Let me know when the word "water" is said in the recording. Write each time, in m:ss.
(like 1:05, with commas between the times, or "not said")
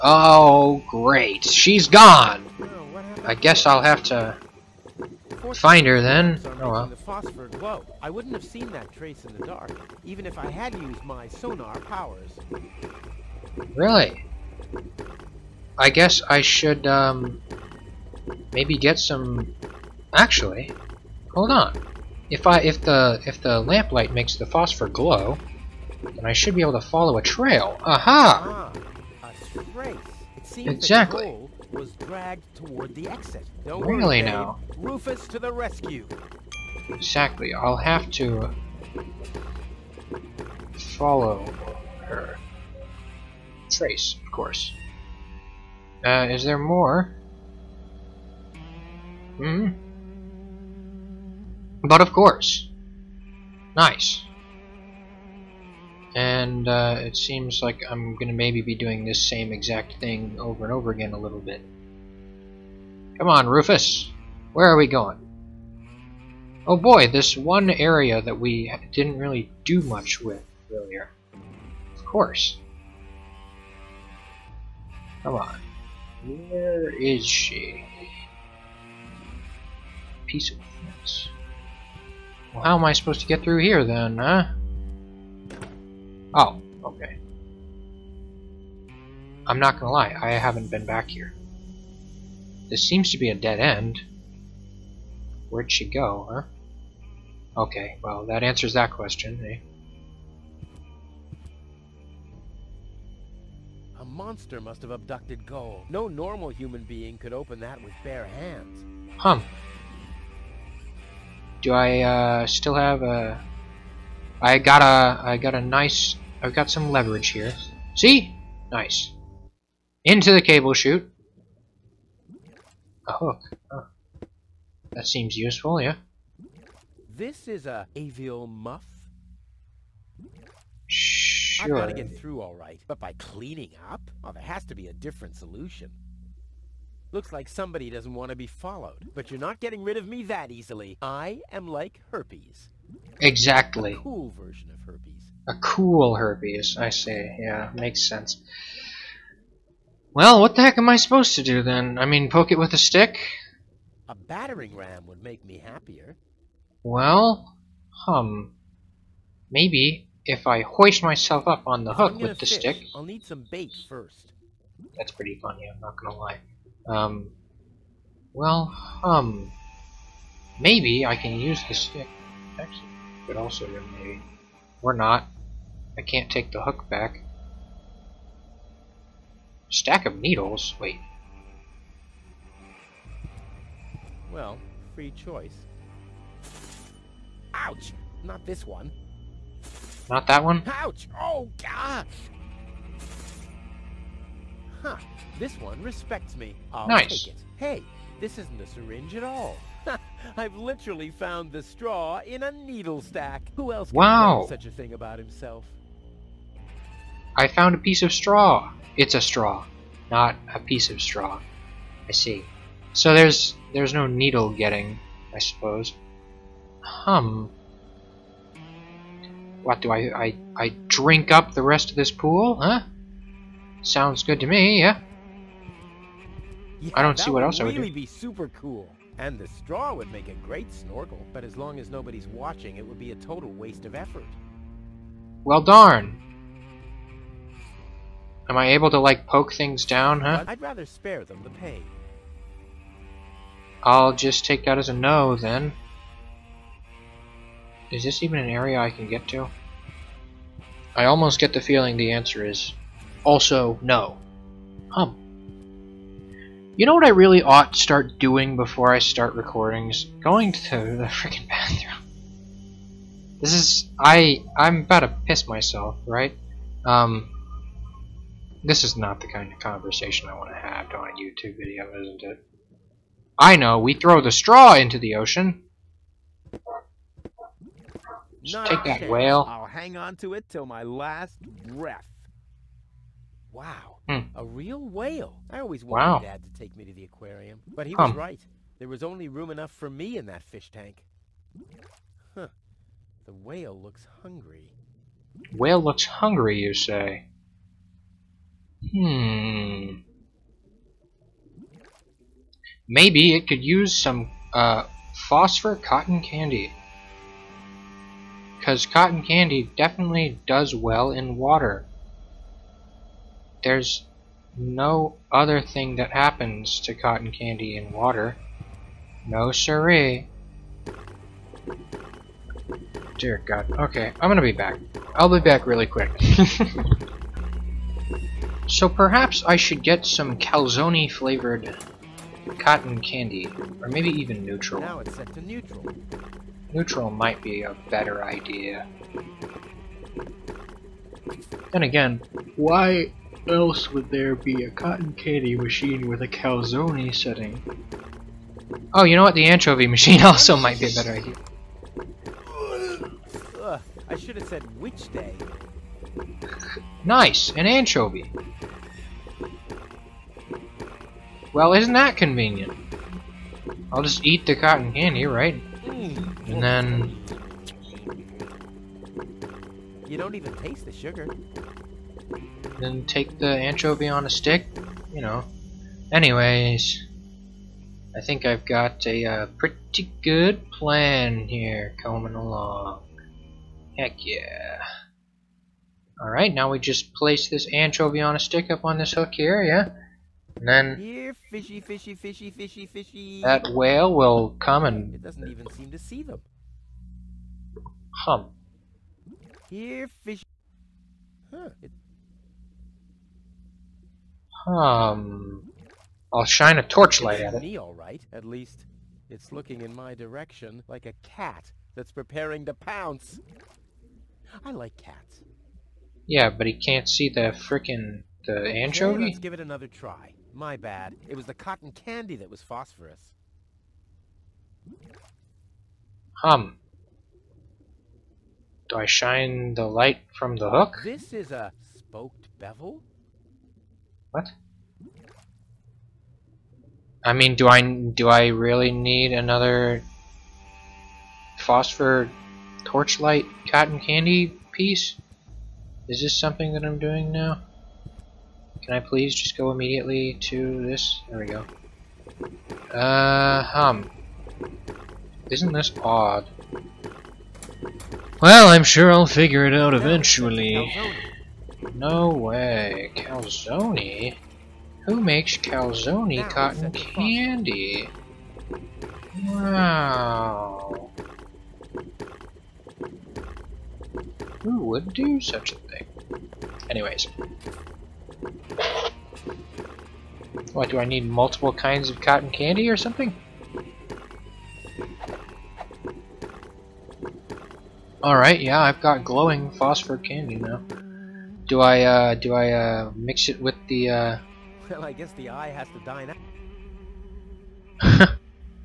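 5:11, 5:17.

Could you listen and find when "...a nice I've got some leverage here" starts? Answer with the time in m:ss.
1:55.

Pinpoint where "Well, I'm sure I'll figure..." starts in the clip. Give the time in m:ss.
7:38.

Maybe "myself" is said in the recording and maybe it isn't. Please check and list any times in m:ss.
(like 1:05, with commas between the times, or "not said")
2:41, 4:25.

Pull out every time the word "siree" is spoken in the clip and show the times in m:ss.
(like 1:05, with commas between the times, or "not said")
5:19.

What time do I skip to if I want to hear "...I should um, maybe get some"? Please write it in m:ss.
0:16.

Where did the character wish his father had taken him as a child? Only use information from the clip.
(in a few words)
The aquarium.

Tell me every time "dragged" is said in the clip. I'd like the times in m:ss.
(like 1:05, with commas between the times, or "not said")
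0:31.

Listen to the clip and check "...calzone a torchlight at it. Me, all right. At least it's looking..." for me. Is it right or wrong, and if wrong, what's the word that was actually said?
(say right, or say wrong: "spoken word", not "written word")
wrong: "shine", not "calzone".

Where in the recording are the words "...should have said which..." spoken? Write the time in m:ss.
5:54.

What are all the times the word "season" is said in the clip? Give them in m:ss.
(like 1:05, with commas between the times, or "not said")
not said.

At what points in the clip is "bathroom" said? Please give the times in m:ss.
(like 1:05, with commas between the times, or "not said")
4:21.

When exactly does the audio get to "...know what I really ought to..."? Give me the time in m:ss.
4:16.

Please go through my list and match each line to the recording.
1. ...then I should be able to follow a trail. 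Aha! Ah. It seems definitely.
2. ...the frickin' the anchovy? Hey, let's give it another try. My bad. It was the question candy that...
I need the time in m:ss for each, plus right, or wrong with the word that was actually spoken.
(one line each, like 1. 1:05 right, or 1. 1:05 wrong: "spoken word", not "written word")
1. 0:26 wrong: "exactly", not "definitely"
2. 6:57 wrong: "cotton", not "question".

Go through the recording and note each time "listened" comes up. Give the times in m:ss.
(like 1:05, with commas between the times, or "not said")
not said.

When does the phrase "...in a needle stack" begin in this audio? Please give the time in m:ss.
3:22.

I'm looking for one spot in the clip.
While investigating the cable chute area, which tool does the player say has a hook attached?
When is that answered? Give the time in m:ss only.
2:42.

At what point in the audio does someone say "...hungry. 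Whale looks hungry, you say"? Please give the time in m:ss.
4:54.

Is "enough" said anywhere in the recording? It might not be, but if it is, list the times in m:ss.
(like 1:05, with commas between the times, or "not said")
4:49.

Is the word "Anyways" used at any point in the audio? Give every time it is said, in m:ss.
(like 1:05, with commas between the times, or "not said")
6:16, 7:56.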